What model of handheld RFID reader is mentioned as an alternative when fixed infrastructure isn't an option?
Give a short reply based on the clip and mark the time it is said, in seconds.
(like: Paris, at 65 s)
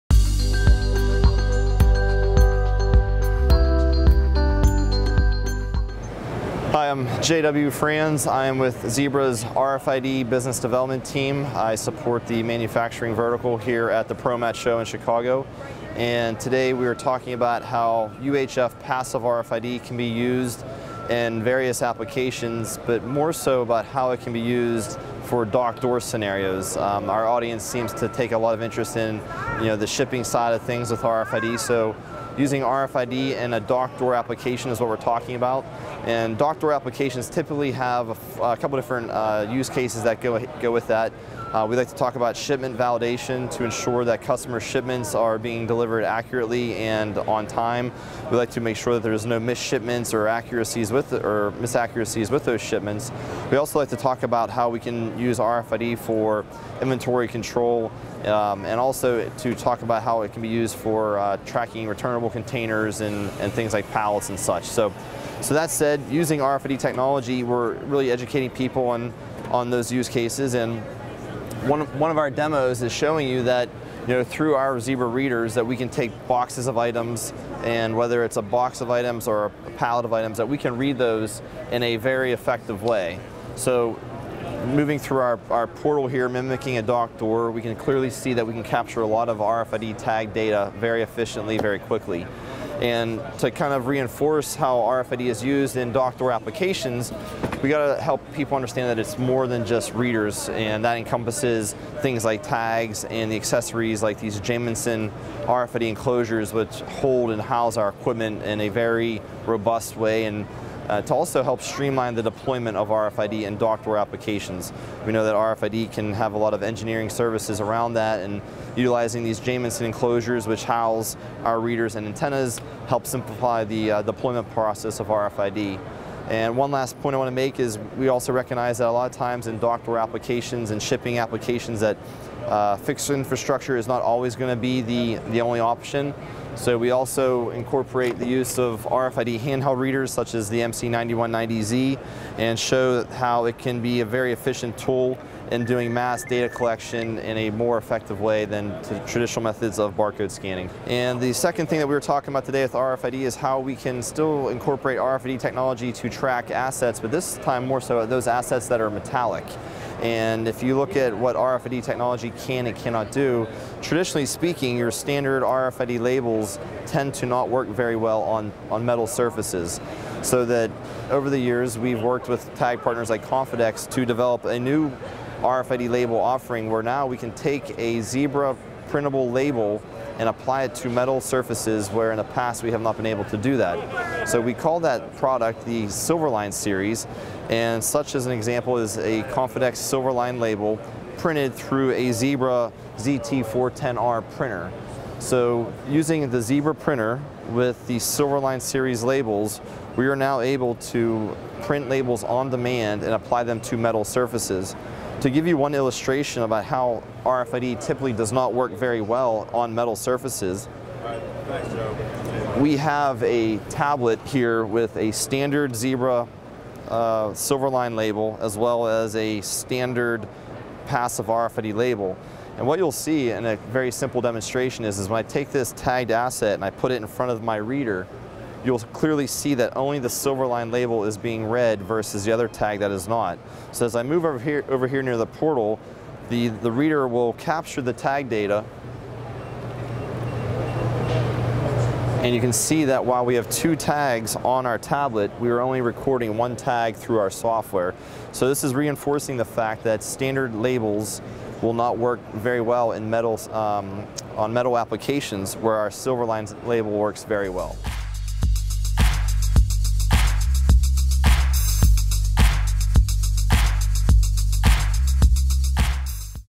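MC9190Z, at 140 s.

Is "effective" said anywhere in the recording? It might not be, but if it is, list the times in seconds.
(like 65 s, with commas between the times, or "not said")
82 s, 147 s.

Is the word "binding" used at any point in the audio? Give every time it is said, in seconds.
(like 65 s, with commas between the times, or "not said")
not said.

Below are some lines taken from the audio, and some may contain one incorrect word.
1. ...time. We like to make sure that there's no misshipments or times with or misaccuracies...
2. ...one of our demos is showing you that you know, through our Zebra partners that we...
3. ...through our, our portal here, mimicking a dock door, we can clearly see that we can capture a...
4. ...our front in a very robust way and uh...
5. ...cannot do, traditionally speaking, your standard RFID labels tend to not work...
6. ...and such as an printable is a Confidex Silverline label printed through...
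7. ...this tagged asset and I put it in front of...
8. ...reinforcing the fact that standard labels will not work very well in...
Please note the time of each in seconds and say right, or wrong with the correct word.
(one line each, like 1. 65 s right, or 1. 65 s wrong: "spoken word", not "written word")
1. 47 s wrong: "accuracies", not "times"
2. 71 s wrong: "readers", not "partners"
3. 84 s right
4. 107 s wrong: "equipment", not "front"
5. 162 s right
6. 187 s wrong: "example", not "printable"
7. 225 s right
8. 248 s right.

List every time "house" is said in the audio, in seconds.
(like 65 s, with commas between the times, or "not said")
107 s, 120 s.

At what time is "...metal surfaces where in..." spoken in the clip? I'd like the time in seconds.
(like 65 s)
180 s.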